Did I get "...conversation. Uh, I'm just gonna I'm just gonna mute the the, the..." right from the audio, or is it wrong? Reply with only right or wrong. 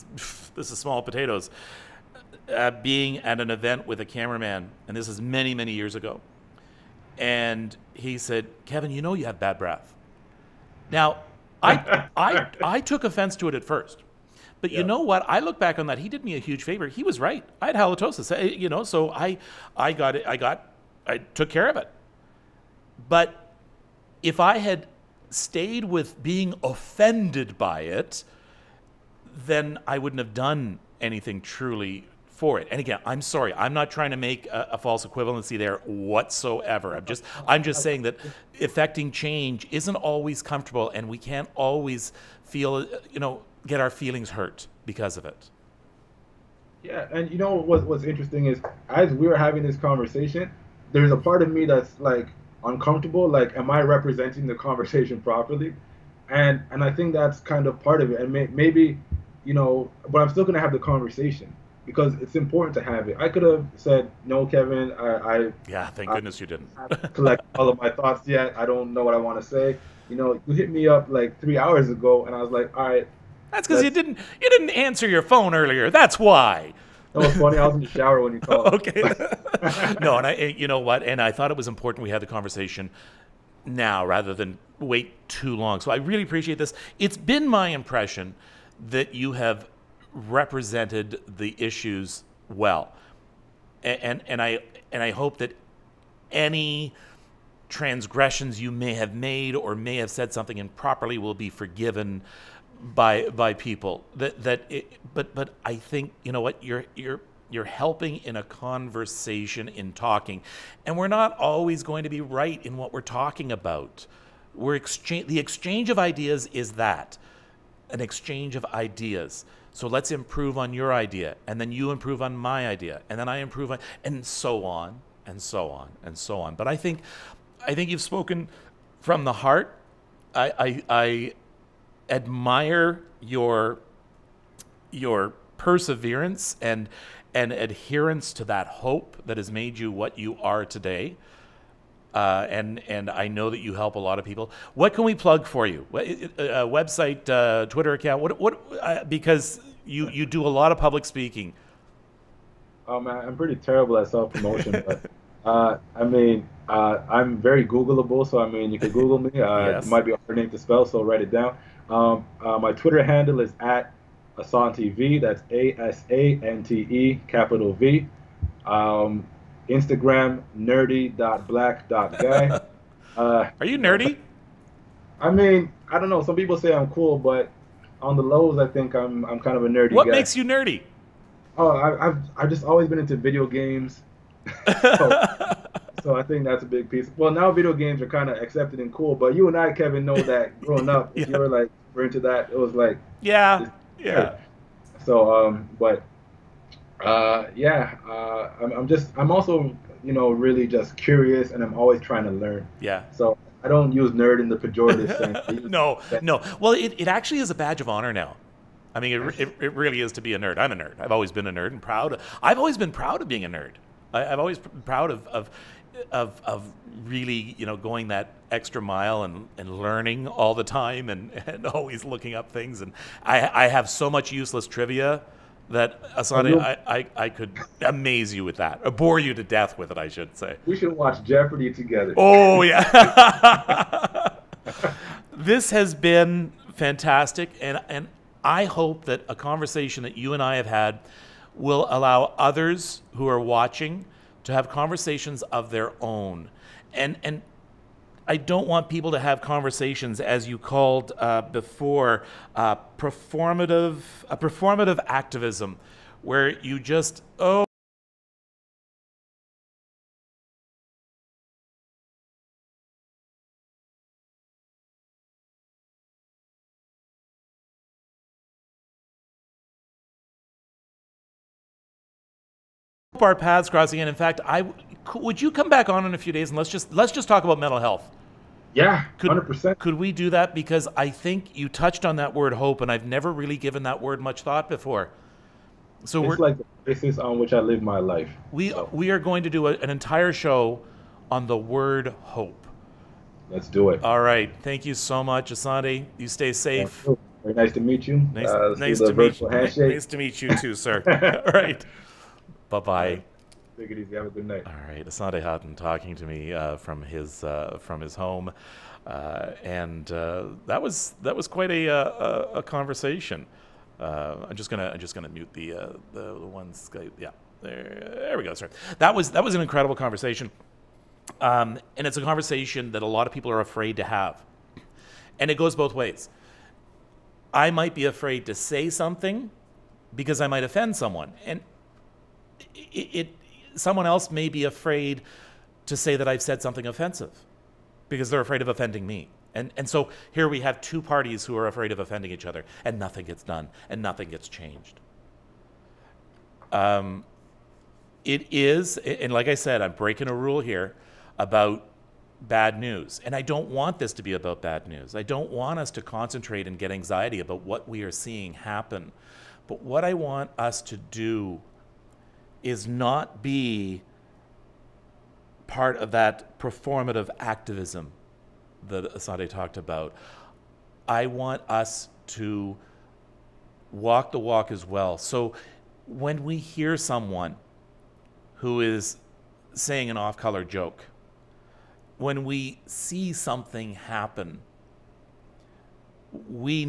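right.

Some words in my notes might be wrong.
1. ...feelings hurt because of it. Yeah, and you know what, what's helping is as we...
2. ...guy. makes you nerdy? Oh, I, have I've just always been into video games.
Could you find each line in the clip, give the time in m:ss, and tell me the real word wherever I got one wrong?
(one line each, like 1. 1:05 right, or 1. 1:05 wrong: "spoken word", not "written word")
1. 0:43 wrong: "interesting", not "helping"
2. 3:00 right.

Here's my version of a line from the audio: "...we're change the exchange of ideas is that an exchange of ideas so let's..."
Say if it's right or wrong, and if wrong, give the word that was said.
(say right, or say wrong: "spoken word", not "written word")
wrong: "exchange", not "change".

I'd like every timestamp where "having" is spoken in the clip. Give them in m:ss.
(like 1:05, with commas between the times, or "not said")
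0:49.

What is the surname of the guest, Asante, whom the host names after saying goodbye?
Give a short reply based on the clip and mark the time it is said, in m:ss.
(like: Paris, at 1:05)
Haughton, at 5:05.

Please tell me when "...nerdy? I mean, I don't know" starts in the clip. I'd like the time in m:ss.
2:53.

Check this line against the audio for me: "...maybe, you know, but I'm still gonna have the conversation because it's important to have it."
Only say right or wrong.
right.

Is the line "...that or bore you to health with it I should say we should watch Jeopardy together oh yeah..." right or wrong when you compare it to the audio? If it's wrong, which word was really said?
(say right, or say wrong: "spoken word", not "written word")
wrong: "death", not "health".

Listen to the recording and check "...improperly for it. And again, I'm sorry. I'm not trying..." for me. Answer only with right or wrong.
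wrong.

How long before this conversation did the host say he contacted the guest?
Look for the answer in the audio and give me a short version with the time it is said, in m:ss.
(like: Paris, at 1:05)
three hours ago, at 1:11.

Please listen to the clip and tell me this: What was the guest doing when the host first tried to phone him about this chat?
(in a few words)
in the shower.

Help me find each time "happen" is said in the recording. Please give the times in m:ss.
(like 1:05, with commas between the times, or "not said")
5:58, 6:23.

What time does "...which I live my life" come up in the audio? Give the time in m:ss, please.
4:47.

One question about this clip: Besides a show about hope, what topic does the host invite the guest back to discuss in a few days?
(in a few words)
mental health.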